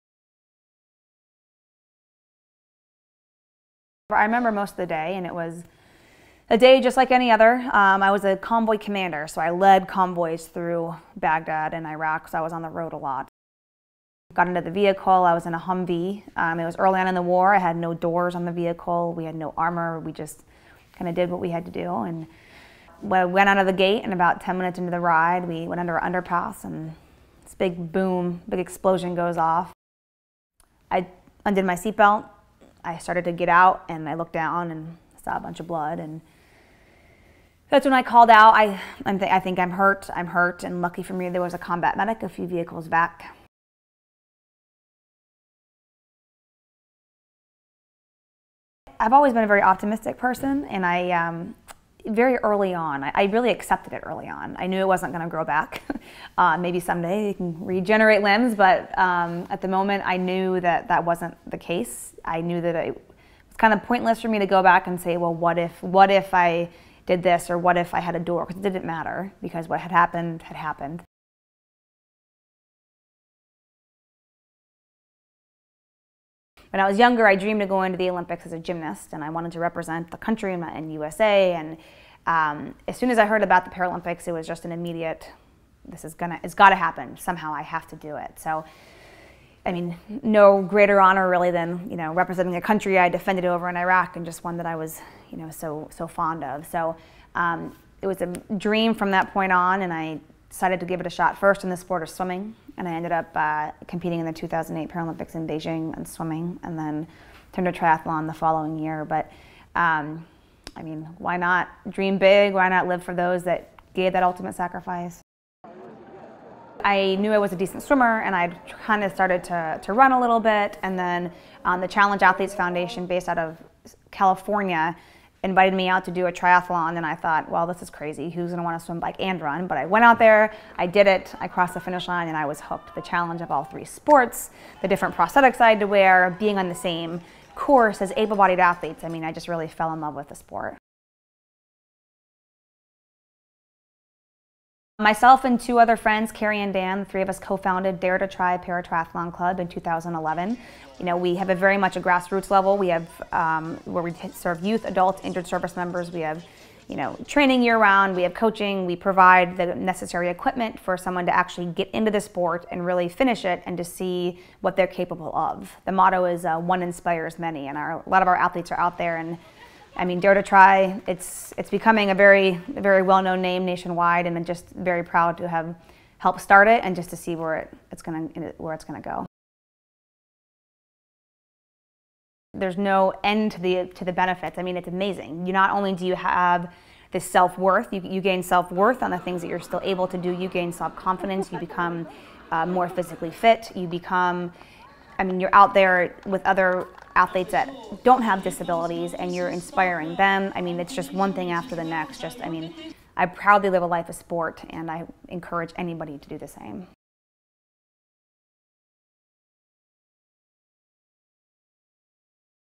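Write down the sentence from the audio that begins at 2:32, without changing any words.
We have um, where we serve youth, adults, injured service members.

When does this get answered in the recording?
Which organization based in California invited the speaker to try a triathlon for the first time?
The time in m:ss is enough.
2:01.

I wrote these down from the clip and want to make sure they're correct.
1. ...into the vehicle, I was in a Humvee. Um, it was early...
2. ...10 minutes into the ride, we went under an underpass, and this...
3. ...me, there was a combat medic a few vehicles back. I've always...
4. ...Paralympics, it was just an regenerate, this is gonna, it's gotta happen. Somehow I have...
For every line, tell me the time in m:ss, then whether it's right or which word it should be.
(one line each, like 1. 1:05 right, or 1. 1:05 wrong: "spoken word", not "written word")
1. 0:14 right
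2. 0:24 right
3. 0:41 right
4. 1:23 wrong: "immediate", not "regenerate".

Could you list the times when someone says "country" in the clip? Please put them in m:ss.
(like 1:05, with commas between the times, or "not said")
1:20, 1:32.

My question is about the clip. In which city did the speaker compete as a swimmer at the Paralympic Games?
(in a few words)
Beijing.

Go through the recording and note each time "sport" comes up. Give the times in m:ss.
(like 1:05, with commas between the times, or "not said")
1:41, 2:13, 2:20, 2:42, 3:24.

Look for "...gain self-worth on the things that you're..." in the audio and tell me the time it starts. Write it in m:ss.
3:08.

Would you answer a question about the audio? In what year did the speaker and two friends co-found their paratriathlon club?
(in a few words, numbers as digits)
2011.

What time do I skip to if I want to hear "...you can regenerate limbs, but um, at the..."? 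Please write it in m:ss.
0:57.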